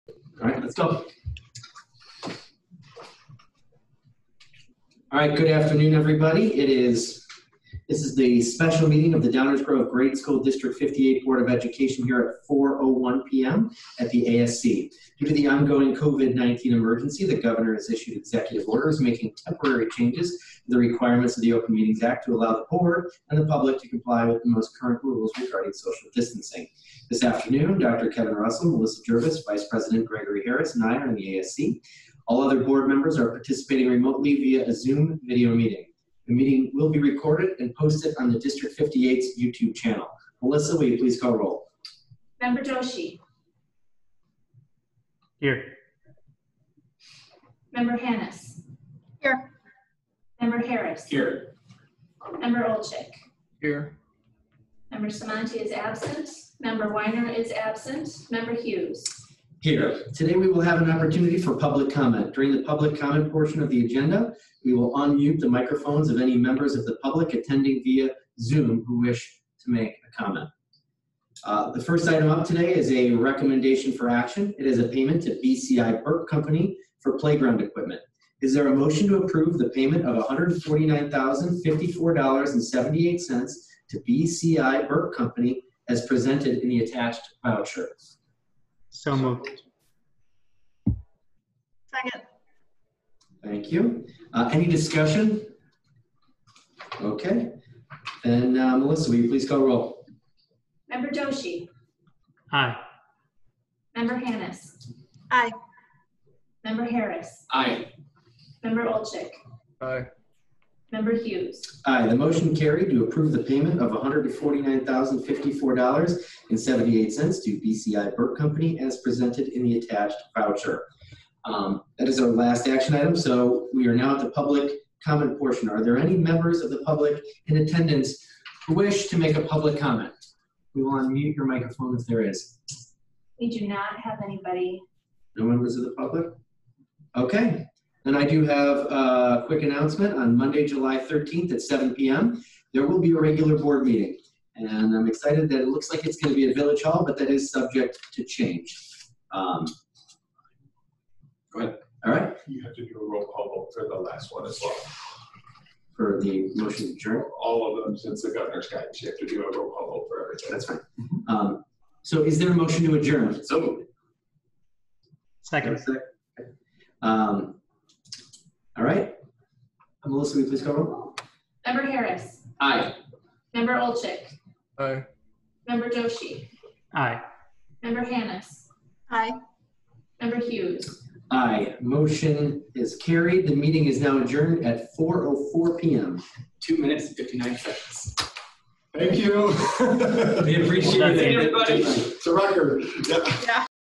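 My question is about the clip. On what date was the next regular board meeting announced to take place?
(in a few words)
Monday, July 13th.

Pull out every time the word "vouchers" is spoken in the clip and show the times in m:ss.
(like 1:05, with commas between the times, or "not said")
1:27, 2:00.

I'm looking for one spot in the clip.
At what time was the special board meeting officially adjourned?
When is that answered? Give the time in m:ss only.
3:04.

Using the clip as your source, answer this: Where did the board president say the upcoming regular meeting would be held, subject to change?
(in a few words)
Village Hall.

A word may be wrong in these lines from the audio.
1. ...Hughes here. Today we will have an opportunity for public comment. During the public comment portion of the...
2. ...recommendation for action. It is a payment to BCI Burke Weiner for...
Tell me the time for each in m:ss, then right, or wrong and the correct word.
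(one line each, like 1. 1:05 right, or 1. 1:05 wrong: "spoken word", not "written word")
1. 0:58 right
2. 1:13 wrong: "Company", not "Weiner".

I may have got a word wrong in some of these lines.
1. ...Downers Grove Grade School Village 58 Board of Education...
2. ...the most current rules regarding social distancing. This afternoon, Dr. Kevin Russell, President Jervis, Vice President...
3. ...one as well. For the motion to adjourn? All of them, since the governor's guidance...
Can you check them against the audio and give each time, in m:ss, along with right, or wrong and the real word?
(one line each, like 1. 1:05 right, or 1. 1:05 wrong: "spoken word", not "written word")
1. 0:09 wrong: "District", not "Village"
2. 0:24 wrong: "Melissa", not "President"
3. 2:34 right.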